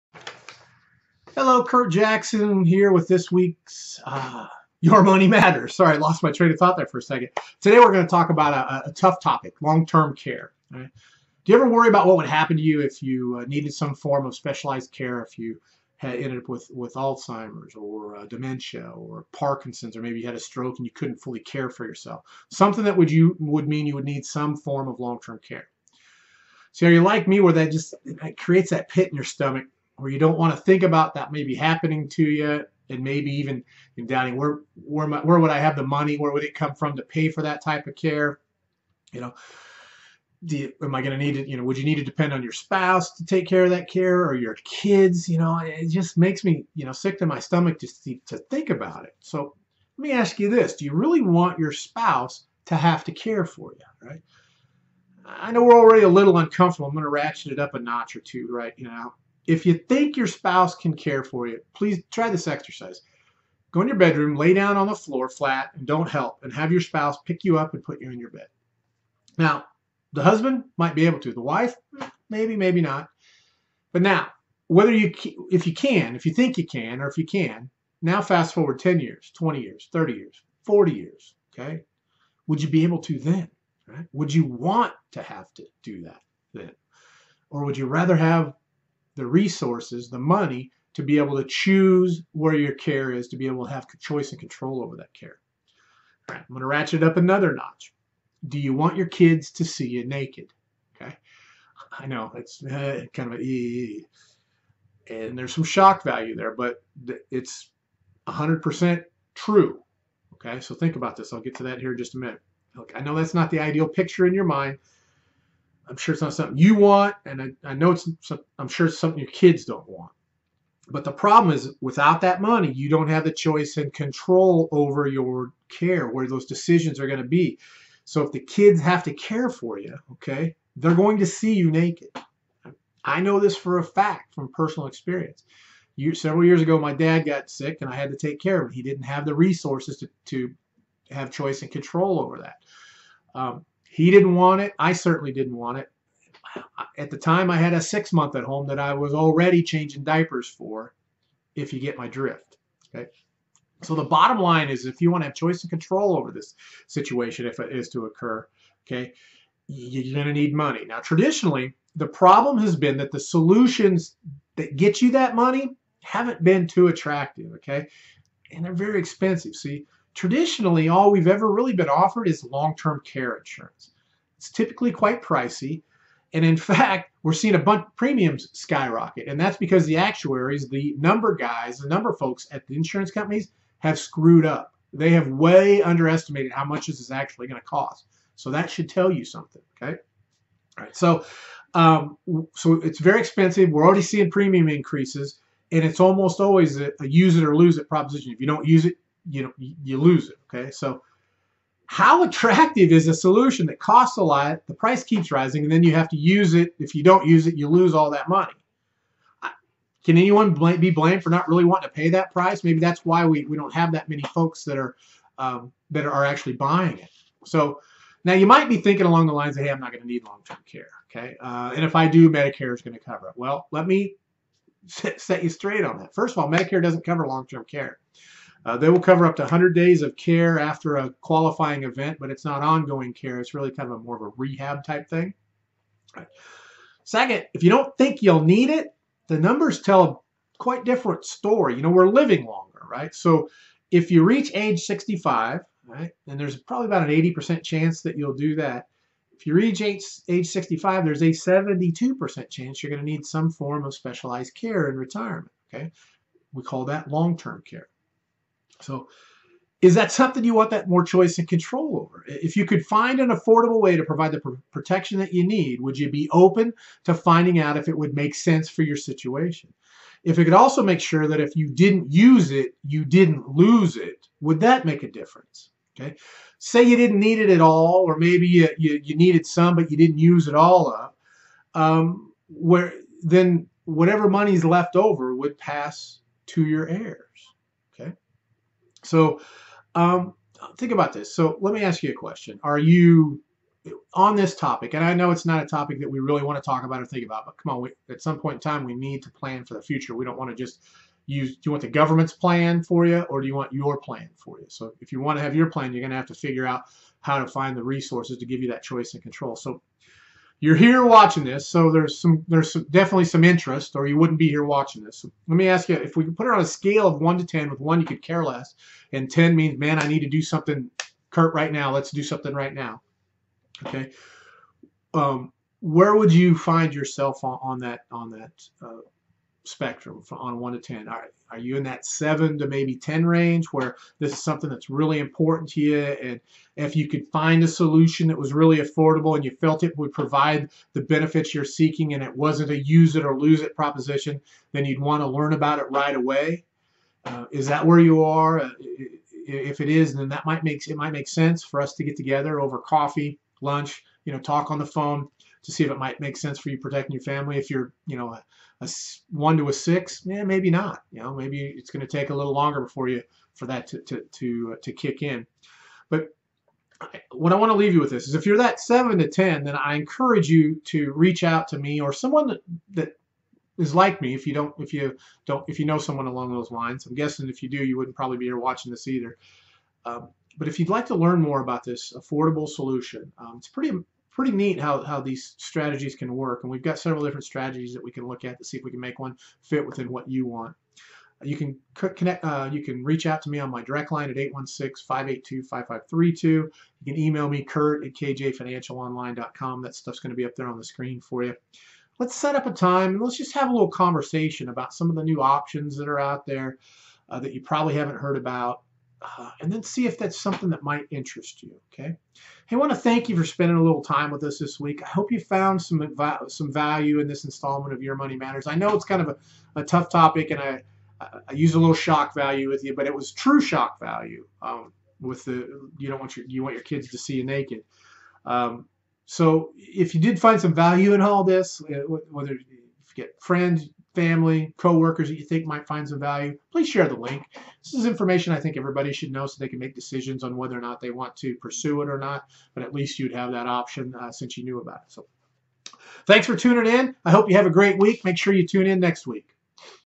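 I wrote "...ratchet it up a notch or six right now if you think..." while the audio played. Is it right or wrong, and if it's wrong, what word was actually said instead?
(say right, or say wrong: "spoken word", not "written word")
wrong: "two", not "six".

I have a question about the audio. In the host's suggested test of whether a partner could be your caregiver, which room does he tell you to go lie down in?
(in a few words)
bedroom.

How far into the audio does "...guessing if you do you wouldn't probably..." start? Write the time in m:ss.
6:17.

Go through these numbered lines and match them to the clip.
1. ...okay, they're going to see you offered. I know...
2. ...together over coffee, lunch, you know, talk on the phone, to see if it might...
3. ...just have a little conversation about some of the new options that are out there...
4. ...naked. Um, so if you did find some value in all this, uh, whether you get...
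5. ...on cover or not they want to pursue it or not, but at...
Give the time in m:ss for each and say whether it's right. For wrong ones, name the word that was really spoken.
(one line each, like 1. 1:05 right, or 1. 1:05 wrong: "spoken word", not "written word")
1. 2:10 wrong: "naked", not "offered"
2. 5:52 right
3. 6:43 right
4. 7:07 right
5. 7:20 wrong: "whether", not "cover".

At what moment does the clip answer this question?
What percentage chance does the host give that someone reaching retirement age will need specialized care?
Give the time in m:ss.
4:11.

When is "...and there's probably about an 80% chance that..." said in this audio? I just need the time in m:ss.
4:06.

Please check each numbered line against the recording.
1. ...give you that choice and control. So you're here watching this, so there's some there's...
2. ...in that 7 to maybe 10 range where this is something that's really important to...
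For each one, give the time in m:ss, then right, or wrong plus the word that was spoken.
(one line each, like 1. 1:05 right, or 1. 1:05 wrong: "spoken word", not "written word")
1. 5:08 right
2. 5:31 right.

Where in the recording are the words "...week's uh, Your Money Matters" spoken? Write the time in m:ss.
0:03.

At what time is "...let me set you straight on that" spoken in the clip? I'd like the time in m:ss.
3:43.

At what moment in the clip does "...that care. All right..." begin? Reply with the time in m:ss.
1:34.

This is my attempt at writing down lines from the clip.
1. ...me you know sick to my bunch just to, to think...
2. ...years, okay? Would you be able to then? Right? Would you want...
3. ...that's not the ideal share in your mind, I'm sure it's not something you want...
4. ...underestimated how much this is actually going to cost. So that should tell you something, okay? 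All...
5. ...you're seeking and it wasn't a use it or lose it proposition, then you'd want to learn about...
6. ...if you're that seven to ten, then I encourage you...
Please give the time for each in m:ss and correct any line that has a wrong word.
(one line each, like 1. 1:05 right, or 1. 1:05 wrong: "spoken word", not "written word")
1. 0:46 wrong: "stomach", not "bunch"
2. 1:20 right
3. 1:53 wrong: "picture", not "share"
4. 3:05 right
5. 5:41 right
6. 6:08 right.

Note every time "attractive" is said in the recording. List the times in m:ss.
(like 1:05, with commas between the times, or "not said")
2:46, 3:22.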